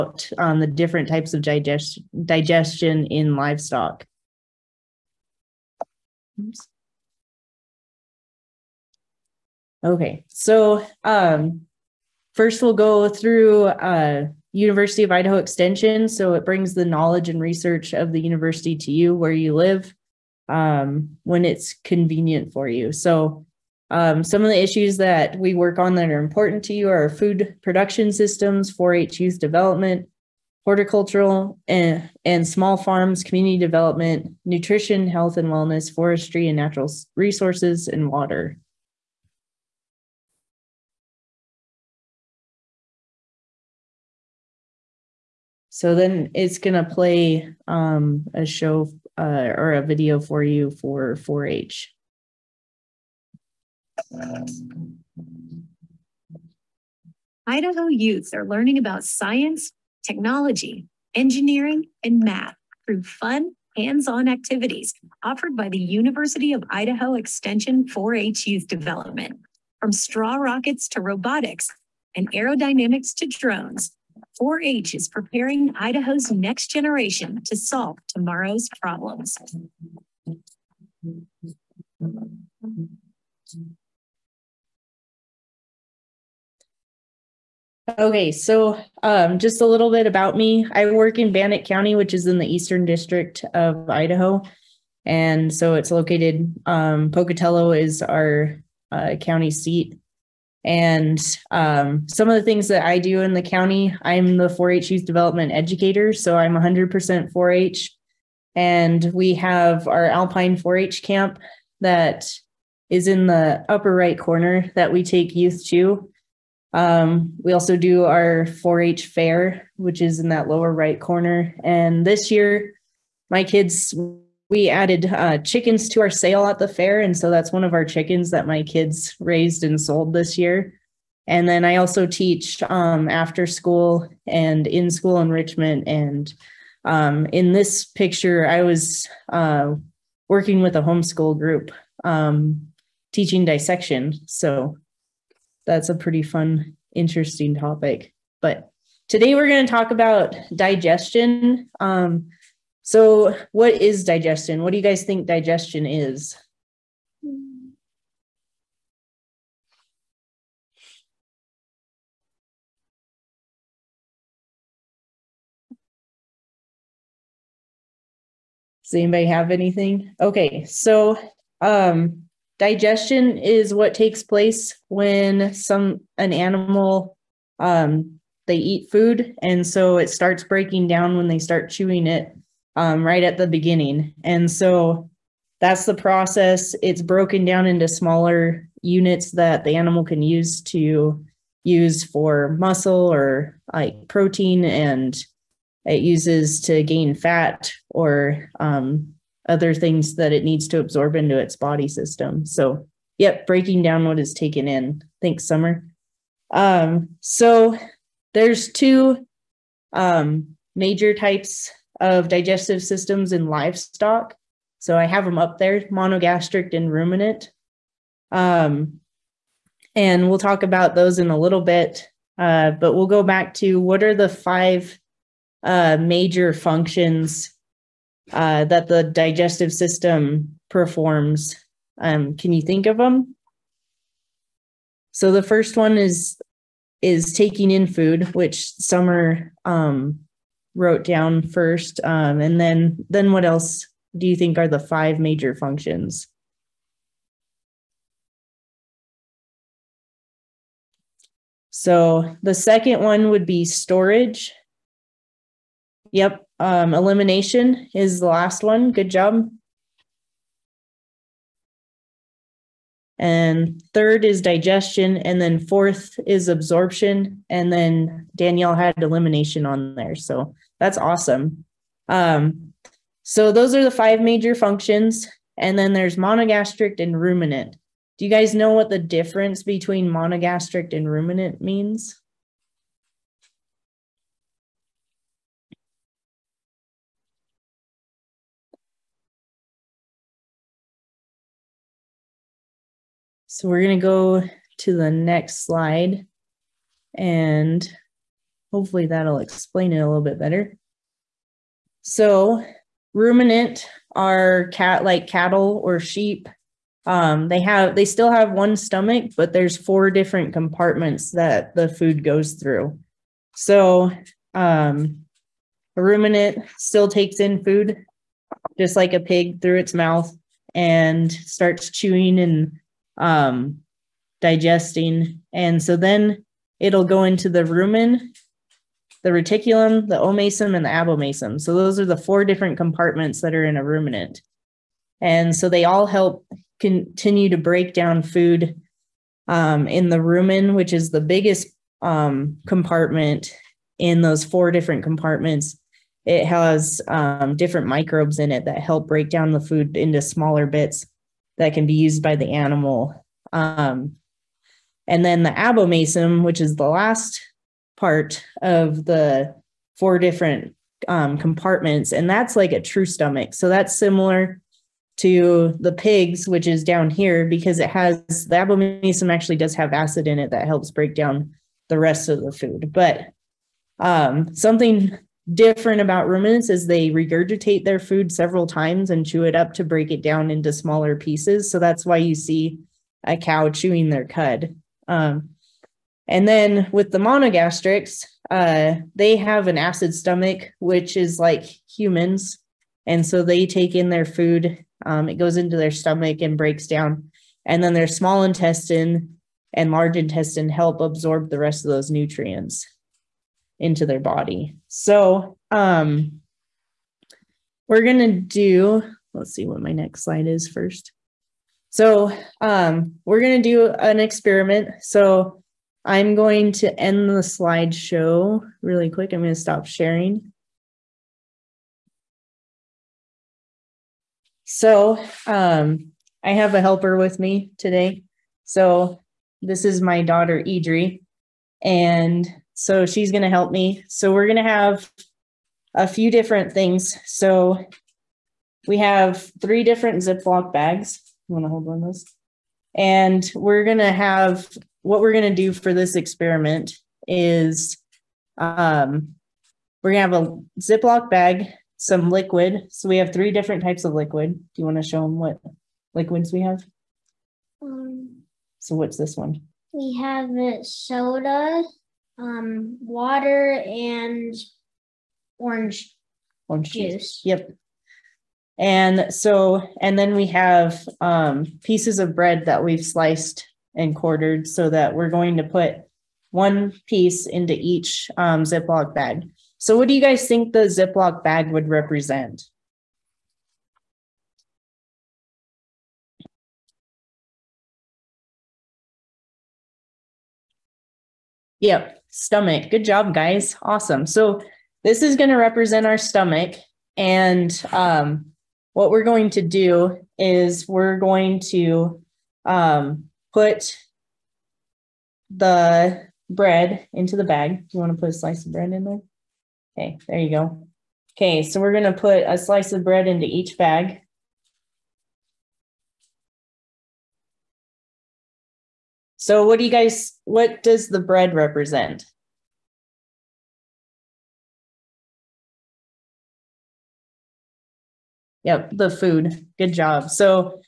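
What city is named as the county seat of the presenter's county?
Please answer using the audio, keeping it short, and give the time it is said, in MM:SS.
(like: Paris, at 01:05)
Pocatello, at 01:37.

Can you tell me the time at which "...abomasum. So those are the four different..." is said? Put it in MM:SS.
05:30.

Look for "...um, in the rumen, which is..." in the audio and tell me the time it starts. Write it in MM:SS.
05:39.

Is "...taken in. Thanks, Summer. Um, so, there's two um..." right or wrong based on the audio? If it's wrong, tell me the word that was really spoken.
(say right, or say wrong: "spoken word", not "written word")
right.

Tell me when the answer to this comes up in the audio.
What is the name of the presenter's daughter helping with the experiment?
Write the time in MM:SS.
07:10.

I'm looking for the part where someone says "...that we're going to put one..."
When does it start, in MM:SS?
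07:54.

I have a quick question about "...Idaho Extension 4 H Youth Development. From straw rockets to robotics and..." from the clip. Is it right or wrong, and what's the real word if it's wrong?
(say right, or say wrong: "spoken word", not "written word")
right.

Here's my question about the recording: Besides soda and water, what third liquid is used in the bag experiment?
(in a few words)
Orange juice.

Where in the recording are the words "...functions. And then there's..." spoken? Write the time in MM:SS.
04:34.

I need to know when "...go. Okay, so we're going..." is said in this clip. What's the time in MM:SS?
08:30.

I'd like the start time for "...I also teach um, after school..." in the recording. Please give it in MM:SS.
02:11.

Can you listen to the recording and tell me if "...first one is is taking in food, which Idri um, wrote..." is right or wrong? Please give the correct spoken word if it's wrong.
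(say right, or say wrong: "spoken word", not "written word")
wrong: "Summer", not "Idri".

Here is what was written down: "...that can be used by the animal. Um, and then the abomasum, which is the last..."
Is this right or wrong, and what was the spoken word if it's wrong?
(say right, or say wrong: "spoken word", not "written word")
right.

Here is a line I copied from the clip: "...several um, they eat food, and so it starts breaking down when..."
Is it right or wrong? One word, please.
wrong.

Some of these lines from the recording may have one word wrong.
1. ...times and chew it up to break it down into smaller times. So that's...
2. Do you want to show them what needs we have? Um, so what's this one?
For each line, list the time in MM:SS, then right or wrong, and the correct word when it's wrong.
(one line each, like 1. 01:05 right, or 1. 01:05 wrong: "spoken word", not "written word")
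1. 06:18 wrong: "pieces", not "times"
2. 07:34 wrong: "liquids", not "needs".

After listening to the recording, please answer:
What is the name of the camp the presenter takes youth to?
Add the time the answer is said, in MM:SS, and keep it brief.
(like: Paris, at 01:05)
Alpine 4-H camp, at 01:50.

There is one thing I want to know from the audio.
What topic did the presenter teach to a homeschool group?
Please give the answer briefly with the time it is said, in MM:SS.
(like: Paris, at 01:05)
Dissection, at 02:23.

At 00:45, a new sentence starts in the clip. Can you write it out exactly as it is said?
So then it's going to play um, a show uh, or a video for you for 4 H.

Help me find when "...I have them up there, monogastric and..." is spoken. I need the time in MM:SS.
03:34.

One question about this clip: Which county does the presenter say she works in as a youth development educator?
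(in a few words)
Bannock County.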